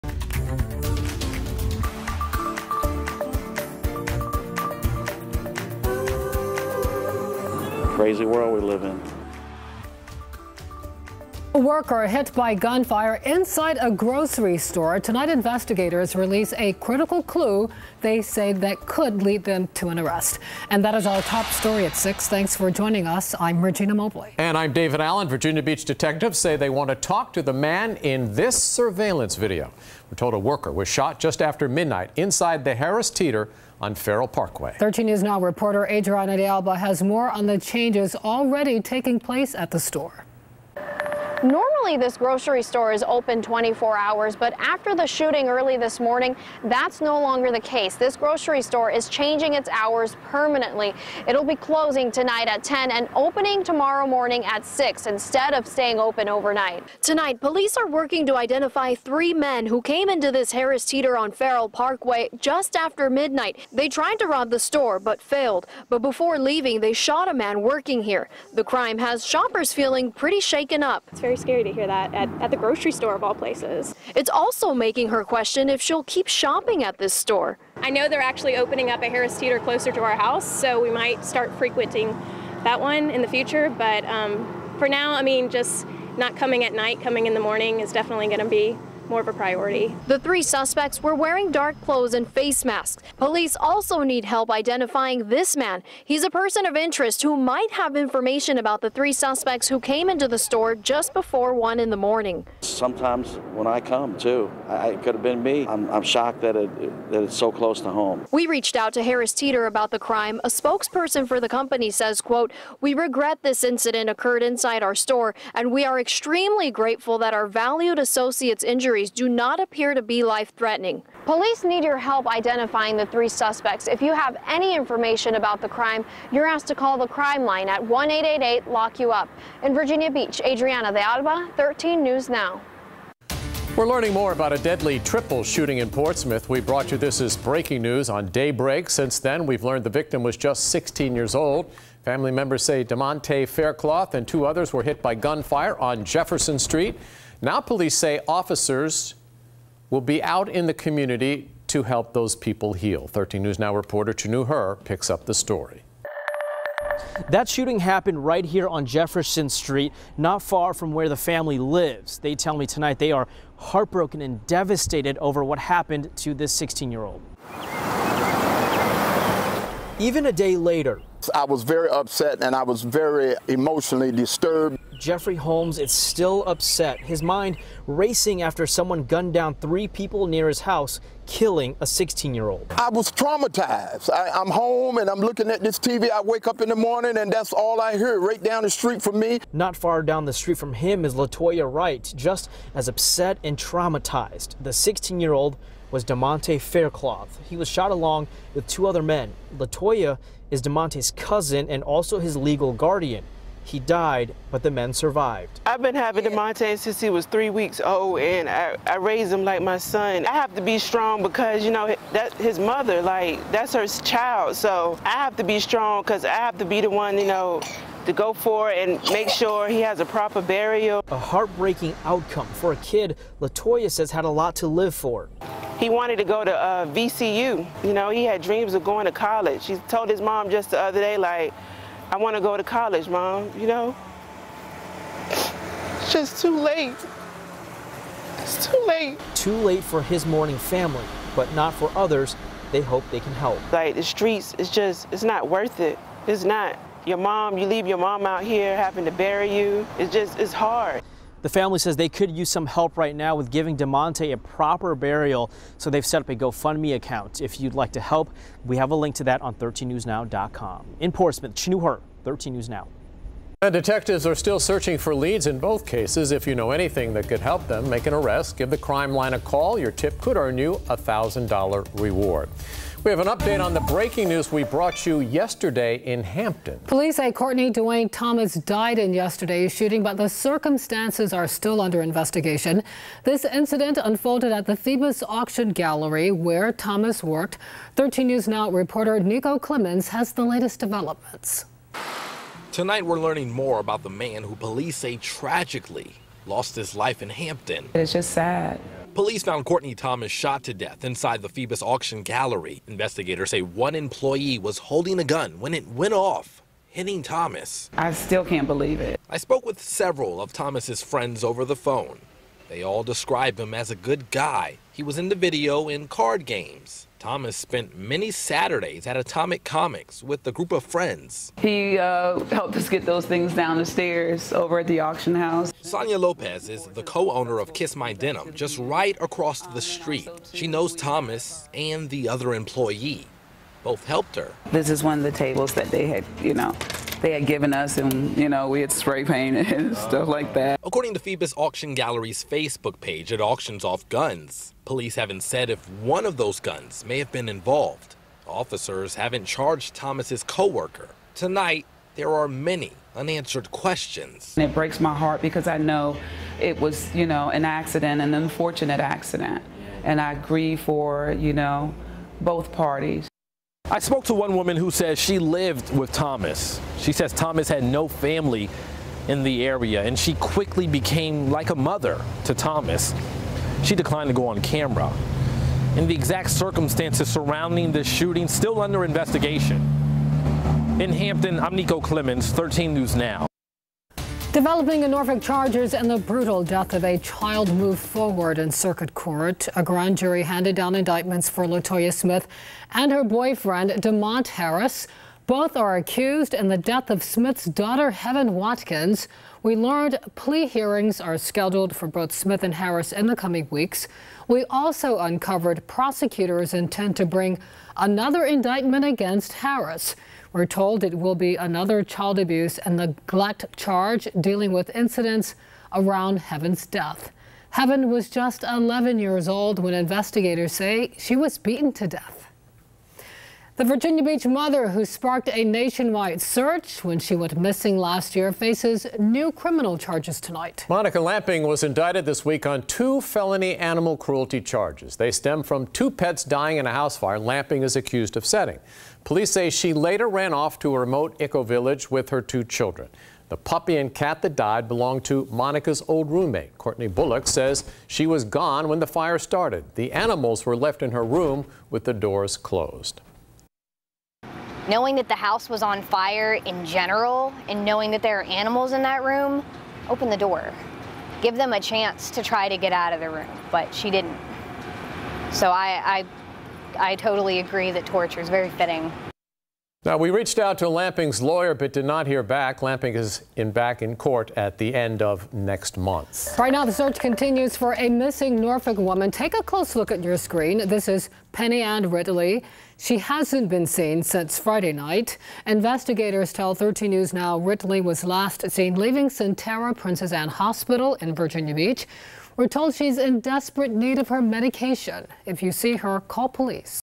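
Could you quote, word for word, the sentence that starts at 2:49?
Even a day later, I was very upset and I was very emotionally disturbed.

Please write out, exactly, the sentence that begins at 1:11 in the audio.
It's very scary hear that at, at the grocery store of all places.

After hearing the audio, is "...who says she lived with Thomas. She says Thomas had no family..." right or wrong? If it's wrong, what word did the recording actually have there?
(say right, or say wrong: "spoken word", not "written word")
right.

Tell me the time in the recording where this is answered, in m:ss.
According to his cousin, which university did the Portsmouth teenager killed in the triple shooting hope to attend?
3:46.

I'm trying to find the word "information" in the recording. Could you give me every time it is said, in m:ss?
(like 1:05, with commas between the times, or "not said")
1:37, 2:04.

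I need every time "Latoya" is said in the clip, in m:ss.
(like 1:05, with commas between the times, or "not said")
3:11, 3:19, 3:43, 6:31.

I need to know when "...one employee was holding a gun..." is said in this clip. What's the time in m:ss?
5:03.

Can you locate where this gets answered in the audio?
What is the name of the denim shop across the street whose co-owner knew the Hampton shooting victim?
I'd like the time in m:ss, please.
5:27.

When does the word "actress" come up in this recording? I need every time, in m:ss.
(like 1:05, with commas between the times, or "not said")
not said.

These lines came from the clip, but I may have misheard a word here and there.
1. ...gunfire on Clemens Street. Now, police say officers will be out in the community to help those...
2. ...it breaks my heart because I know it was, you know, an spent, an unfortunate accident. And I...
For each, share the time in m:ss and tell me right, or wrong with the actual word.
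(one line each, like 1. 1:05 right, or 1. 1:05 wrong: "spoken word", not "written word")
1. 2:25 wrong: "Jefferson", not "Clemens"
2. 5:54 wrong: "accident", not "spent".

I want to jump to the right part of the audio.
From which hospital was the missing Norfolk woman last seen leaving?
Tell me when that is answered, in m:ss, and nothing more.
8:09.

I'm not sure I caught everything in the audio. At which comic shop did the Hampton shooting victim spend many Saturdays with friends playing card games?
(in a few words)
Atomic Comics.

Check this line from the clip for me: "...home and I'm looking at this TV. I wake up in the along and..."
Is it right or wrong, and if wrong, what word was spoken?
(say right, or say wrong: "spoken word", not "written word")
wrong: "morning", not "along".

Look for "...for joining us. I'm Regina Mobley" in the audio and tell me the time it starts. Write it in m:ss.
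0:22.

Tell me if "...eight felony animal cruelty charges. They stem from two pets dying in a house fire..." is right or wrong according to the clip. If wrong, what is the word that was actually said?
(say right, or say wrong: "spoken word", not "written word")
wrong: "two", not "eight".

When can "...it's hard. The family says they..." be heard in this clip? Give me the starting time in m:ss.
4:10.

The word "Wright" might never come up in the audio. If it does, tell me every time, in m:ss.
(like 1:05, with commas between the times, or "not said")
3:11.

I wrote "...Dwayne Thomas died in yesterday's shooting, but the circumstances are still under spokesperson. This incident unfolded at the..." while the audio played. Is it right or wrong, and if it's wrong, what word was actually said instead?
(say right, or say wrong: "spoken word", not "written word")
wrong: "investigation", not "spokesperson".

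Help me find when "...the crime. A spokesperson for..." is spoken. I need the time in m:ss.
1:49.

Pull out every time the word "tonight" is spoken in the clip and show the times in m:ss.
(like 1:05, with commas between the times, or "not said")
0:15, 0:52, 0:57, 2:42, 4:52, 5:51, 7:10.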